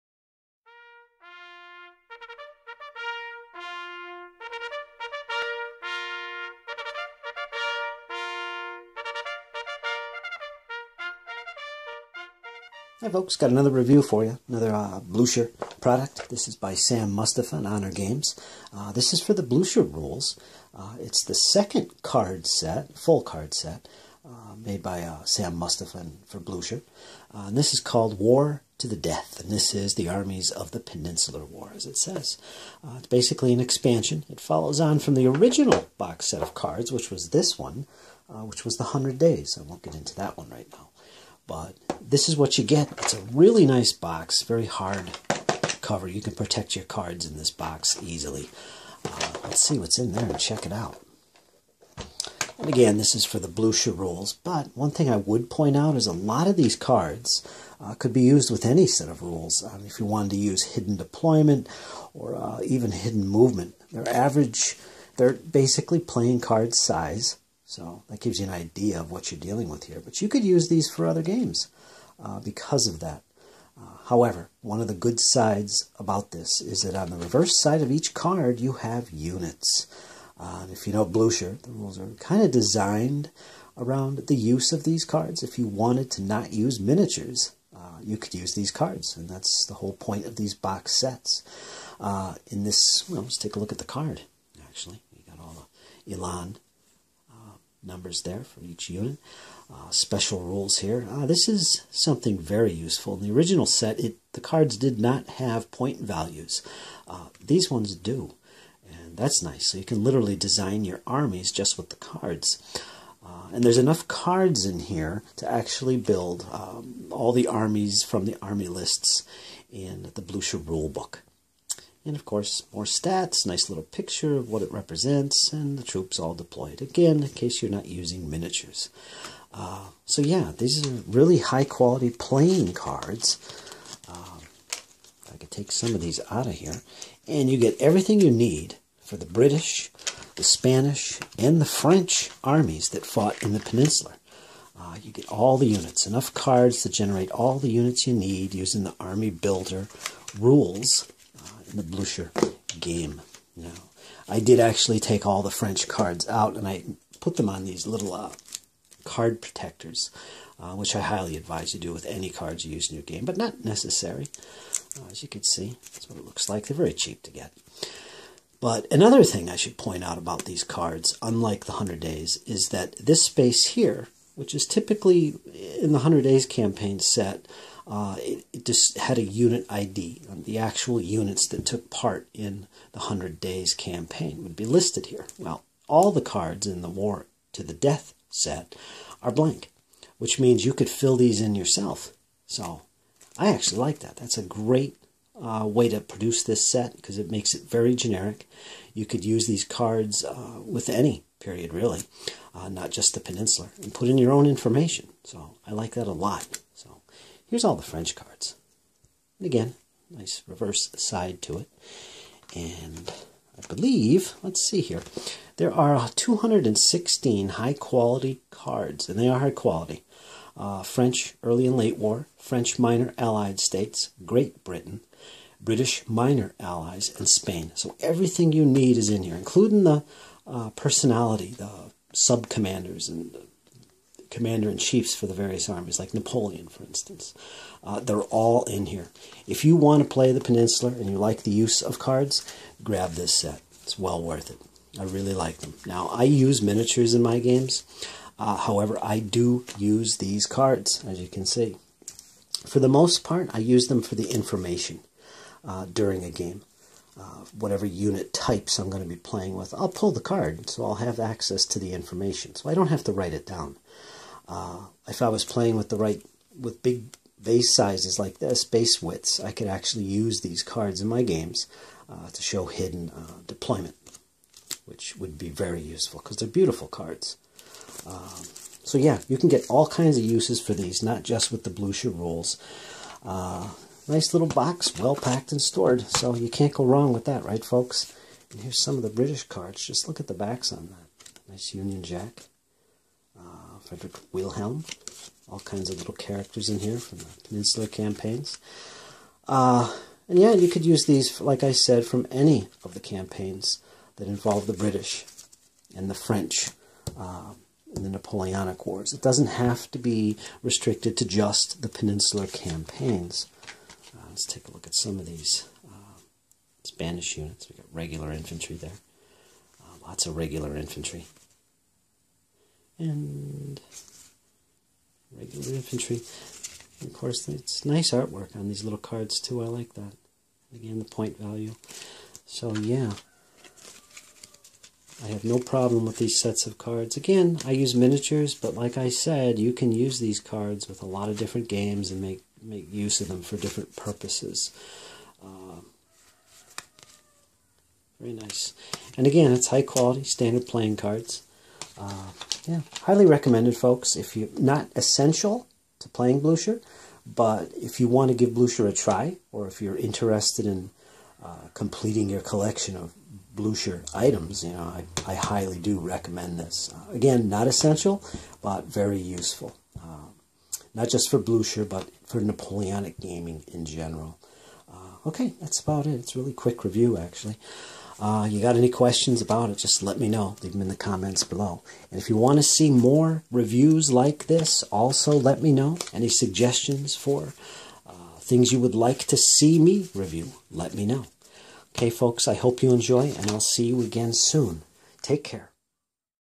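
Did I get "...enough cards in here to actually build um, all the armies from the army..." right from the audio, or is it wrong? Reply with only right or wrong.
right.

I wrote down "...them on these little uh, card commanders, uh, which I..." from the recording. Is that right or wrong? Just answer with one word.
wrong.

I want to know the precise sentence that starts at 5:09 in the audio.
It doesn't have to be restricted to just the Peninsular campaigns.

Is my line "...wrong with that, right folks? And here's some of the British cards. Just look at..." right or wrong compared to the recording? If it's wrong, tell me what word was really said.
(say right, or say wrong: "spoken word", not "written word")
right.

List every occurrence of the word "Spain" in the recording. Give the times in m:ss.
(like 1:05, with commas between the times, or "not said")
3:47.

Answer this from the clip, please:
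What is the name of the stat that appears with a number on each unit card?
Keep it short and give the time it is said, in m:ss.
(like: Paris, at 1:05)
Elan, at 1:36.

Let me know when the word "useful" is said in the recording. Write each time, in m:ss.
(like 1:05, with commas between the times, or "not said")
1:42, 4:35, 6:09.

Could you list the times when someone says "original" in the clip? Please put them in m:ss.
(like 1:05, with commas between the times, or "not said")
0:35, 1:43.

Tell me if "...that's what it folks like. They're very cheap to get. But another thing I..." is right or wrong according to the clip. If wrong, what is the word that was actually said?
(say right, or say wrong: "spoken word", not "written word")
wrong: "looks", not "folks".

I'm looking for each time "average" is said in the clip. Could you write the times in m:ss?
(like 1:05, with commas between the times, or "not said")
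1:04.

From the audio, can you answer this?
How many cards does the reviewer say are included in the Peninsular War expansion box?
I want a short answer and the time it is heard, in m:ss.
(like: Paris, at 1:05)
216, at 3:36.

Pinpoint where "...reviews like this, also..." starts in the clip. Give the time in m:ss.
6:23.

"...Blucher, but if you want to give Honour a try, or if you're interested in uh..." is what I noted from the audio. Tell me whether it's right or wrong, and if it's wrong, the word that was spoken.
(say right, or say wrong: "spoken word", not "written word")
wrong: "Blucher", not "Honour".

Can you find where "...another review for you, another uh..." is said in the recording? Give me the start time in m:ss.
0:13.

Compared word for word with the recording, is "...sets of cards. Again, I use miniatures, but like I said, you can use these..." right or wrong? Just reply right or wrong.
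right.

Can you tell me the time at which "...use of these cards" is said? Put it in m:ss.
1:24.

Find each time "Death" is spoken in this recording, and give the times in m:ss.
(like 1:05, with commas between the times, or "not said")
0:28, 3:07.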